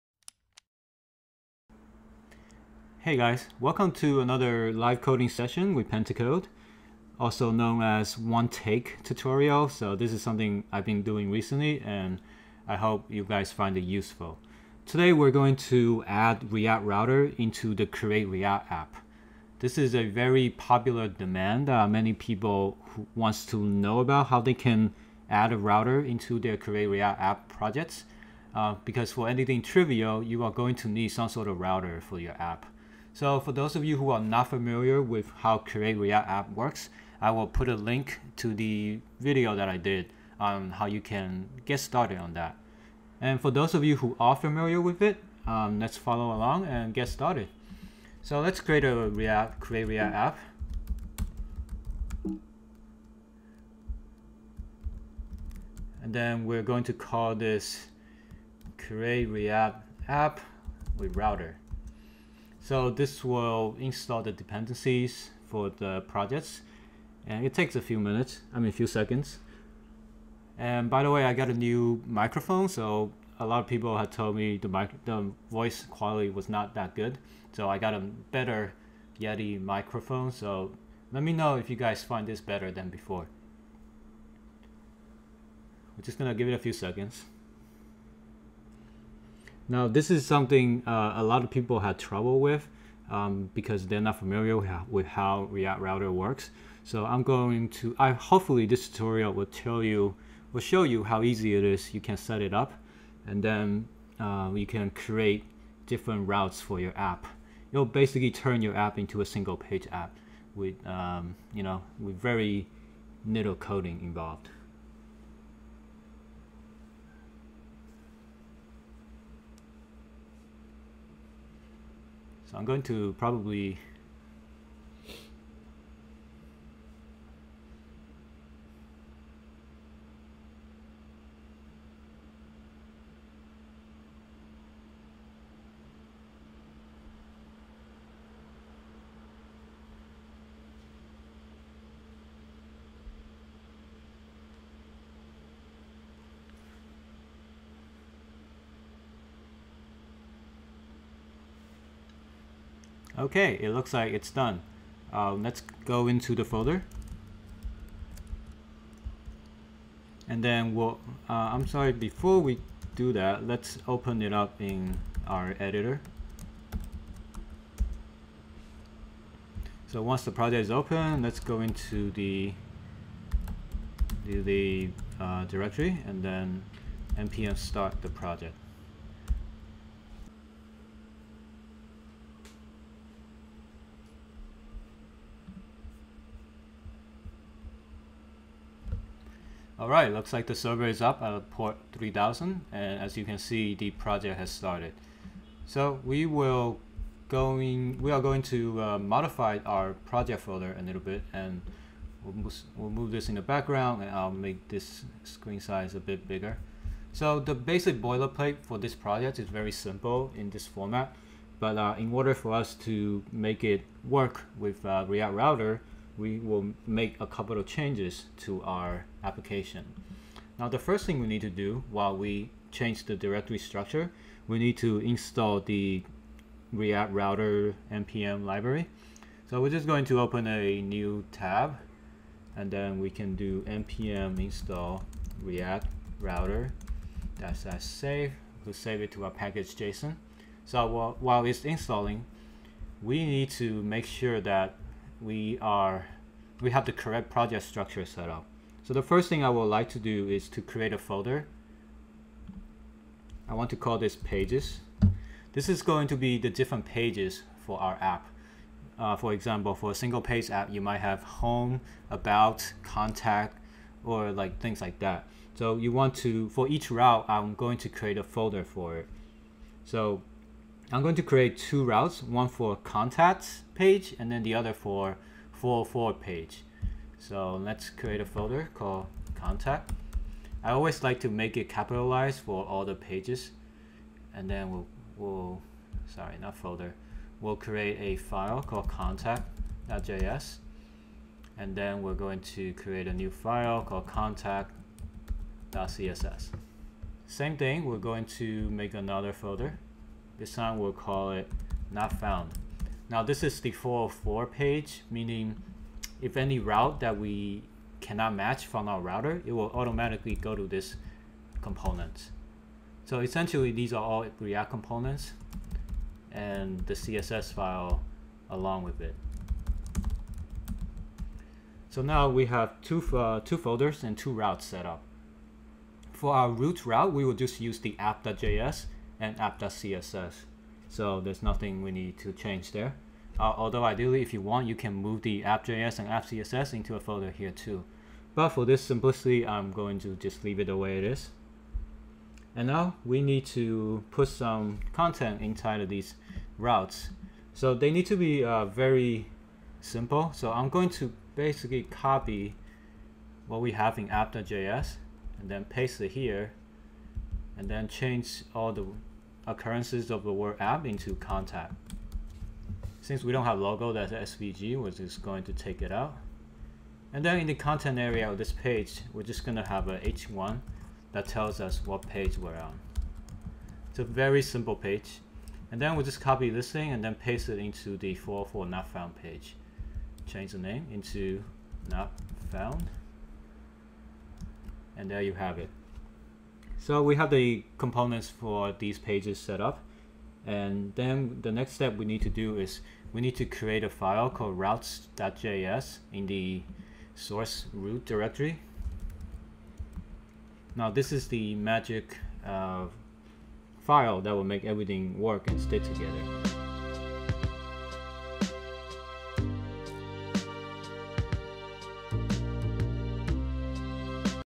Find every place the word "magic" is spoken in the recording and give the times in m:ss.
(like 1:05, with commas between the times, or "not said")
6:41.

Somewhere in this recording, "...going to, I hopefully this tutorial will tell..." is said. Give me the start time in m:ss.
1:37.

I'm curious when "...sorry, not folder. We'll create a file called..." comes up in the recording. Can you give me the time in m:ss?
4:46.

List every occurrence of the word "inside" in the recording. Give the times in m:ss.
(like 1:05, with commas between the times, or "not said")
5:45.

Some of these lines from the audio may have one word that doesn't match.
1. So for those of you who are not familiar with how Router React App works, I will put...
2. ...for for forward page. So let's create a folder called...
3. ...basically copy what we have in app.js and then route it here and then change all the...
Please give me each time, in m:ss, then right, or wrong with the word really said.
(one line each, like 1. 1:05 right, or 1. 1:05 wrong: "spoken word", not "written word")
1. 0:33 wrong: "Create", not "Router"
2. 4:34 right
3. 5:51 wrong: "paste", not "route".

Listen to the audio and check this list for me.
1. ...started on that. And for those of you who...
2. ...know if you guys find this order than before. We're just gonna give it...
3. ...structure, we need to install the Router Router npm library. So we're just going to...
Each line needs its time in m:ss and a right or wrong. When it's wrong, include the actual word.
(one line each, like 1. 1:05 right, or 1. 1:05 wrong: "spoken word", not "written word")
1. 0:41 right
2. 1:21 wrong: "better", not "order"
3. 3:43 wrong: "React", not "Router".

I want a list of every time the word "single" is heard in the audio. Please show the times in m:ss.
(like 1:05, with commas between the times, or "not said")
1:49, 4:19.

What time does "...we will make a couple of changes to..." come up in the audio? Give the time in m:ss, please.
3:36.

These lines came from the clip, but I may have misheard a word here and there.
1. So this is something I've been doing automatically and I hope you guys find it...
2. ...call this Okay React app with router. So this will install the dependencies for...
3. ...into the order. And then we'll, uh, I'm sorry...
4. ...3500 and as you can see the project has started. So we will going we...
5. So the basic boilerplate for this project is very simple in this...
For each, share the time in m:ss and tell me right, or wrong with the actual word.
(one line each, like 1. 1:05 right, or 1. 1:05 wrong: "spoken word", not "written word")
1. 0:09 wrong: "recently", not "automatically"
2. 0:56 wrong: "Create", not "Okay"
3. 2:36 wrong: "folder", not "order"
4. 3:11 wrong: "3000", not "3500"
5. 3:27 right.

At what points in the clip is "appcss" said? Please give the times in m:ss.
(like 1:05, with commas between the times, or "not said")
5:29, 5:36.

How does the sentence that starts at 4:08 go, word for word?
So the first thing I would like to do is to create a folder.